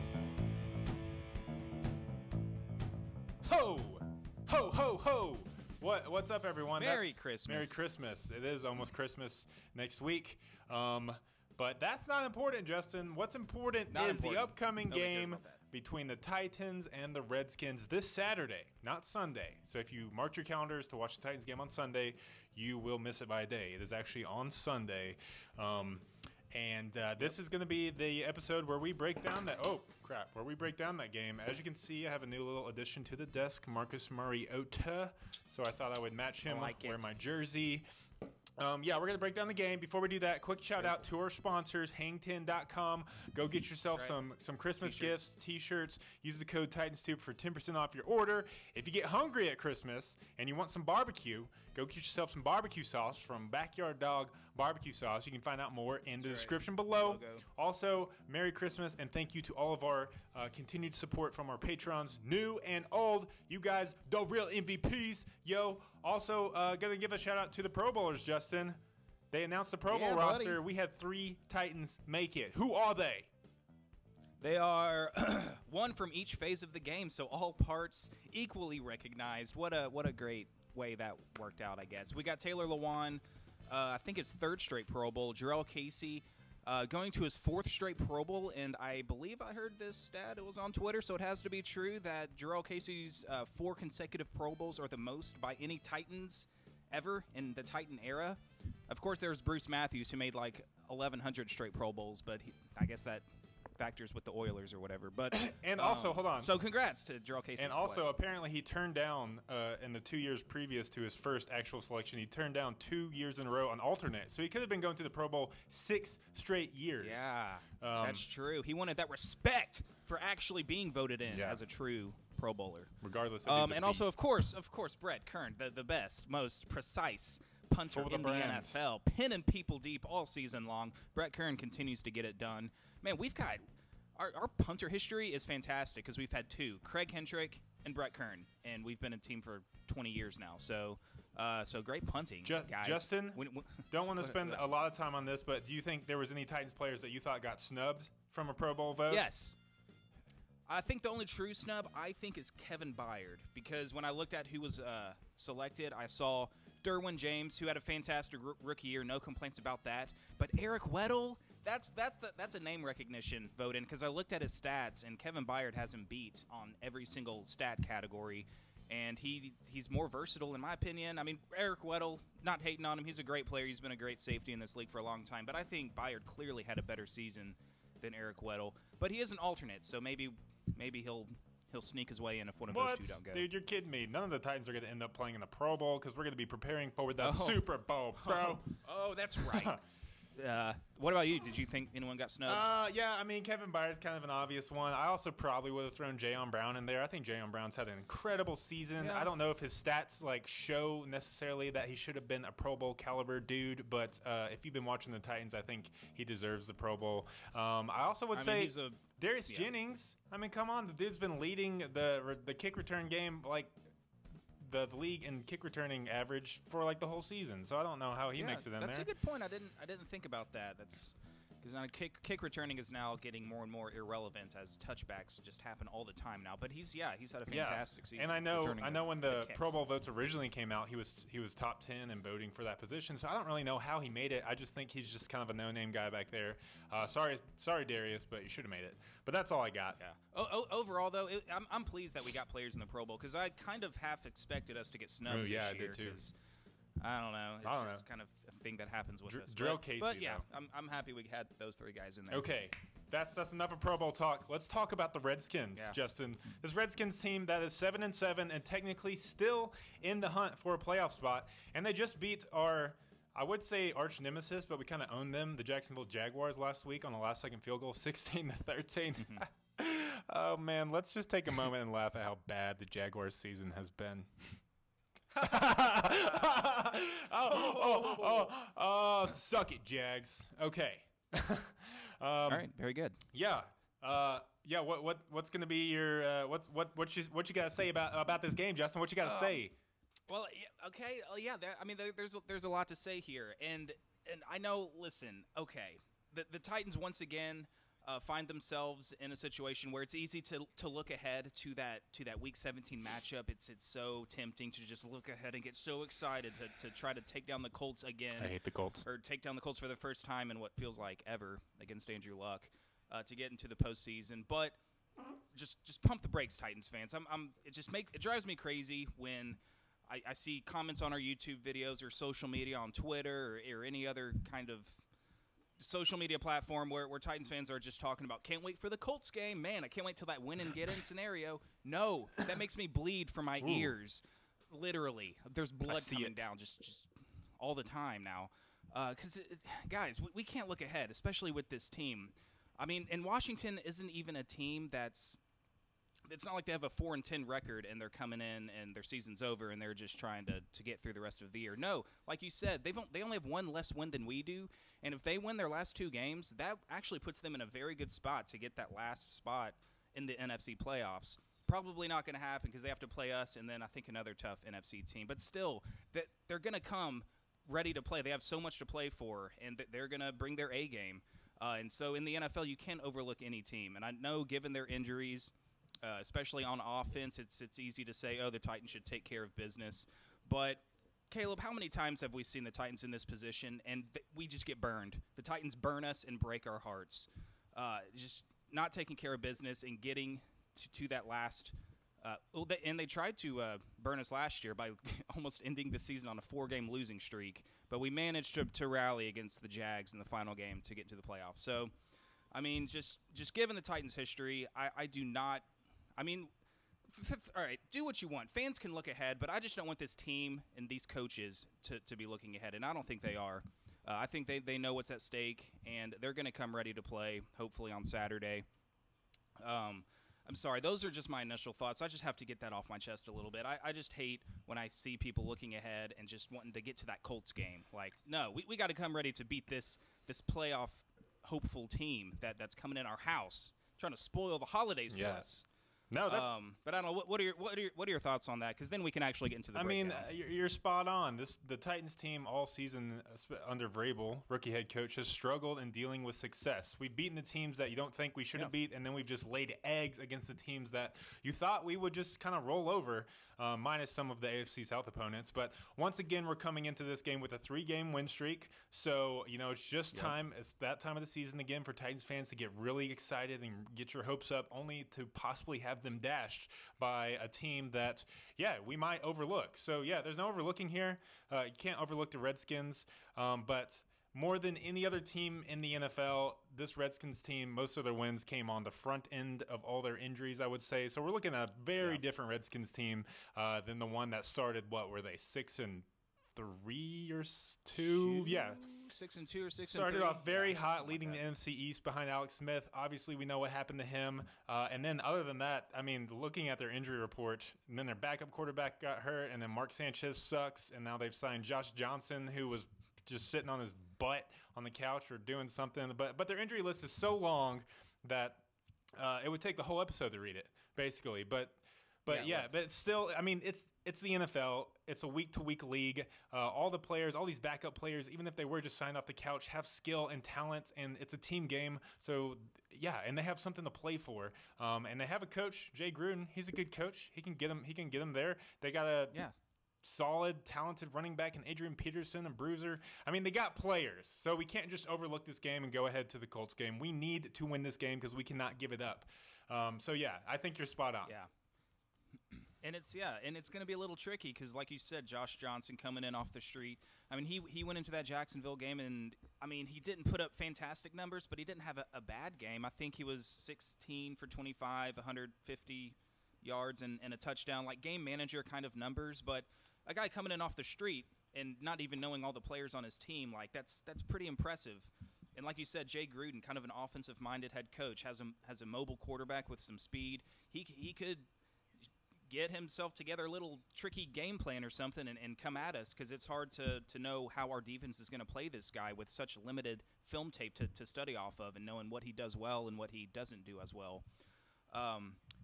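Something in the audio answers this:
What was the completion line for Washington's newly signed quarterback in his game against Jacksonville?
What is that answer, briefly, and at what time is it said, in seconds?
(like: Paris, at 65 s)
16 for 25, at 553 s.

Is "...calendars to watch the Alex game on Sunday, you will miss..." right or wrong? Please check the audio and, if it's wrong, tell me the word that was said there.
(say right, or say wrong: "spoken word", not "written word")
wrong: "Titans", not "Alex".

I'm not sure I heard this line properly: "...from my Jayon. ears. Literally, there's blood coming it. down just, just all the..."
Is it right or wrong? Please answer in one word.
wrong.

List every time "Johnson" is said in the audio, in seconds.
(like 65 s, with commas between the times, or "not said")
501 s, 545 s.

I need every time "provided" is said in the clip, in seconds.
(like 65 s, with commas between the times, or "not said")
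not said.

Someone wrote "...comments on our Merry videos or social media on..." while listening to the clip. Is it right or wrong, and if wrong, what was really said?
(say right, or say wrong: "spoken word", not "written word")
wrong: "YouTube", not "Merry".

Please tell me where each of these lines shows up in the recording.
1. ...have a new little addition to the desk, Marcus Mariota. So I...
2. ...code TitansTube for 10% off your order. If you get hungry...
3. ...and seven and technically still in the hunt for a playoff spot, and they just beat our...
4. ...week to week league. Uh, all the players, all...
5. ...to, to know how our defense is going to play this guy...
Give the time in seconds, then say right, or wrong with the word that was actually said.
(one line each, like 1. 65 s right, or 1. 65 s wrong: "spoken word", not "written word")
1. 32 s right
2. 46 s right
3. 258 s right
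4. 515 s right
5. 576 s right.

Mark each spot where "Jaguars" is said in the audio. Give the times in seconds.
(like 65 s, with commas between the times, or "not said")
266 s, 272 s.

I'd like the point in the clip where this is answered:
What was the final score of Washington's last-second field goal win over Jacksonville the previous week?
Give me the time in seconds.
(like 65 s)
267 s.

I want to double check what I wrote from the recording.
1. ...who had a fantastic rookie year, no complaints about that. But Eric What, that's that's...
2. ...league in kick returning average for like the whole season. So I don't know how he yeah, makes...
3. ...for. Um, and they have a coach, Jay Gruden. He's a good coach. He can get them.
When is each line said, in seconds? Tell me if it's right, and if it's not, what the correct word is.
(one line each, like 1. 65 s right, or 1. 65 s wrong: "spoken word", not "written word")
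1. 157 s wrong: "Weddle", not "What"
2. 214 s right
3. 524 s right.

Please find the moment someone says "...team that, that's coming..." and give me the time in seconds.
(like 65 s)
431 s.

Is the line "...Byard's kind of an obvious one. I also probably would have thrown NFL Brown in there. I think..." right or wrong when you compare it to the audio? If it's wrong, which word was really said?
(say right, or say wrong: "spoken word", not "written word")
wrong: "Jayon", not "NFL".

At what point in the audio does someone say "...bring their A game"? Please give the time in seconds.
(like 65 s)
370 s.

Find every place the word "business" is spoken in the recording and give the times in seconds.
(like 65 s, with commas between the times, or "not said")
379 s, 389 s.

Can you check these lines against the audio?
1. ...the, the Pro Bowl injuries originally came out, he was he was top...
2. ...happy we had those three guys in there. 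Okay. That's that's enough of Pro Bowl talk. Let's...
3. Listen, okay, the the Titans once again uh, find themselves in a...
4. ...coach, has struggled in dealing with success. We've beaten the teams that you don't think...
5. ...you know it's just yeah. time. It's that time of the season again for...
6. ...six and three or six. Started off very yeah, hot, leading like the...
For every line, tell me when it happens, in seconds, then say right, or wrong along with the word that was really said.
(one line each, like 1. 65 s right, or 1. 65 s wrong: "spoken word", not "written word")
1. 229 s wrong: "votes", not "injuries"
2. 250 s right
3. 294 s right
4. 444 s right
5. 459 s right
6. 489 s wrong: "two", not "three".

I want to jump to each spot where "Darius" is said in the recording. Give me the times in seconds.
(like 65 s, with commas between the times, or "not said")
209 s, 237 s.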